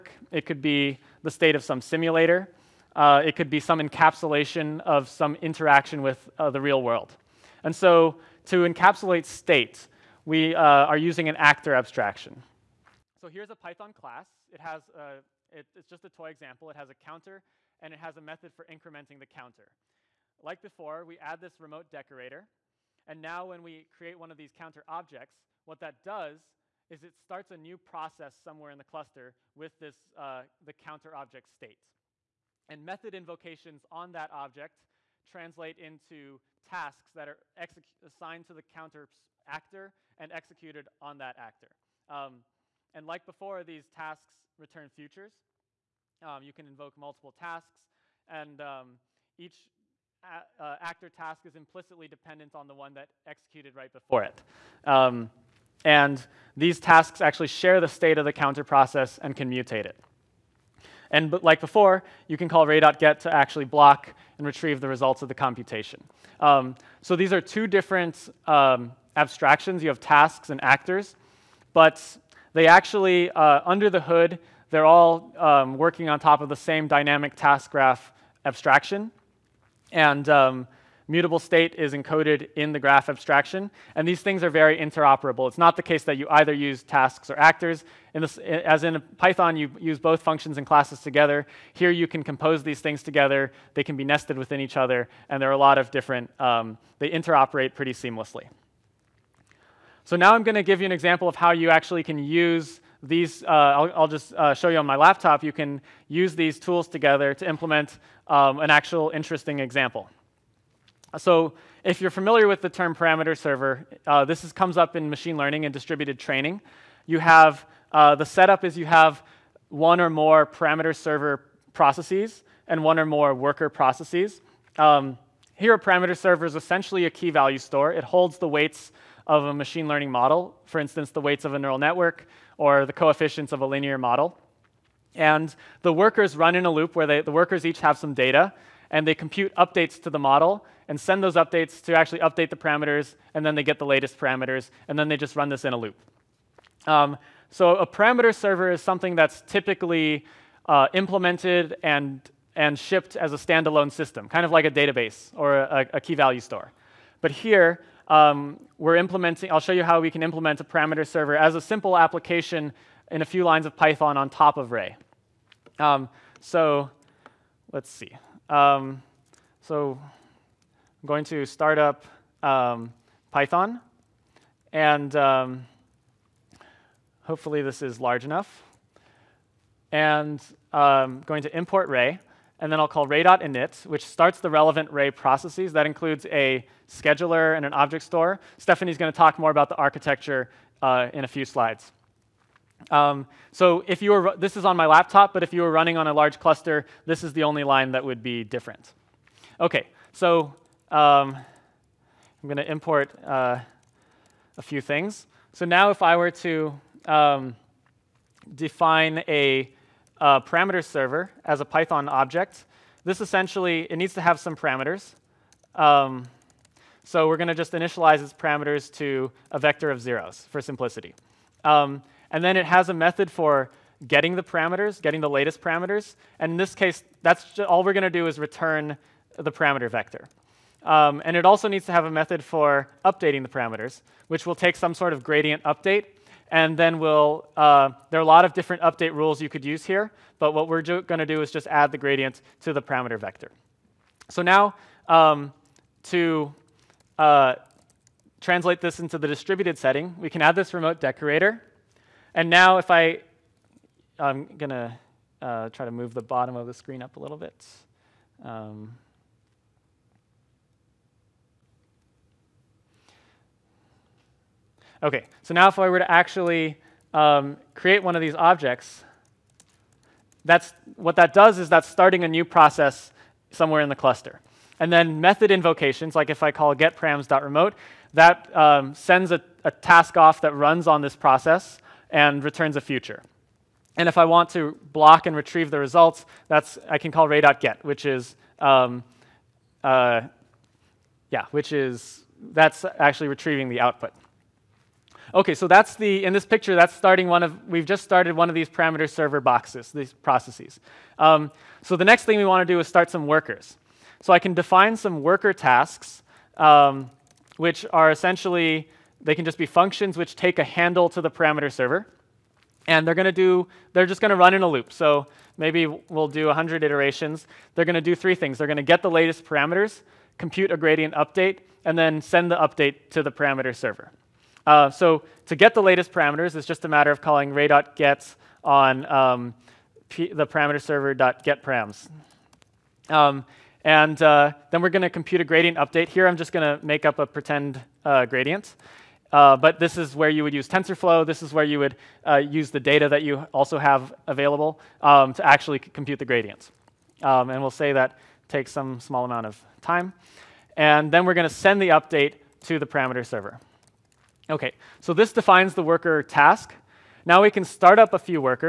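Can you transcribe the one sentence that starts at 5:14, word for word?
So maybe we'll do 100 iterations.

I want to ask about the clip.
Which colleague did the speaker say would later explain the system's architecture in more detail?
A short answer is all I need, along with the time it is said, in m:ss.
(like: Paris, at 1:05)
Stephanie, at 3:08.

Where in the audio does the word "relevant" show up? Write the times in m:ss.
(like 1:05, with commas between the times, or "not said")
3:04.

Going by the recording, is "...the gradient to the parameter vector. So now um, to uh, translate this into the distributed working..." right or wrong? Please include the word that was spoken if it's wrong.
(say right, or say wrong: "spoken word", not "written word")
wrong: "setting", not "working".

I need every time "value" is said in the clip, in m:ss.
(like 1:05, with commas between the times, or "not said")
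2:07, 2:36.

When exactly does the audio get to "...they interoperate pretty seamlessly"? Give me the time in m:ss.
1:36.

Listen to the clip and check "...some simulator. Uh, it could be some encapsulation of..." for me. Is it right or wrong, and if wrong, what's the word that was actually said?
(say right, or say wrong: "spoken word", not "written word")
right.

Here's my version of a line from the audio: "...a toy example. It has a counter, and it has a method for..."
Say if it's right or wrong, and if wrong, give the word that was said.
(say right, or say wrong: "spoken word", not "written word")
right.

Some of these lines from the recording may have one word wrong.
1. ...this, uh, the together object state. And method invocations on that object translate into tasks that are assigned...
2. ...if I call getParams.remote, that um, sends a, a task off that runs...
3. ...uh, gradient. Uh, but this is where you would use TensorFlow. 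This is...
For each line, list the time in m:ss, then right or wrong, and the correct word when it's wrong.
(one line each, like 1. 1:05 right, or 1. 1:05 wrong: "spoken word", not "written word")
1. 0:29 wrong: "counter", not "together"
2. 4:36 right
3. 5:38 right.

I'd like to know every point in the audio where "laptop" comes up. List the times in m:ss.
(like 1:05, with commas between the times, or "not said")
1:44, 3:14.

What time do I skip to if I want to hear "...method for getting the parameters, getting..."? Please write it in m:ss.
3:42.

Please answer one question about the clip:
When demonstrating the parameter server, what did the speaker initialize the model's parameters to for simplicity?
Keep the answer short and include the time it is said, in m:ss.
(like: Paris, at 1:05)
A vector of zeros, at 3:39.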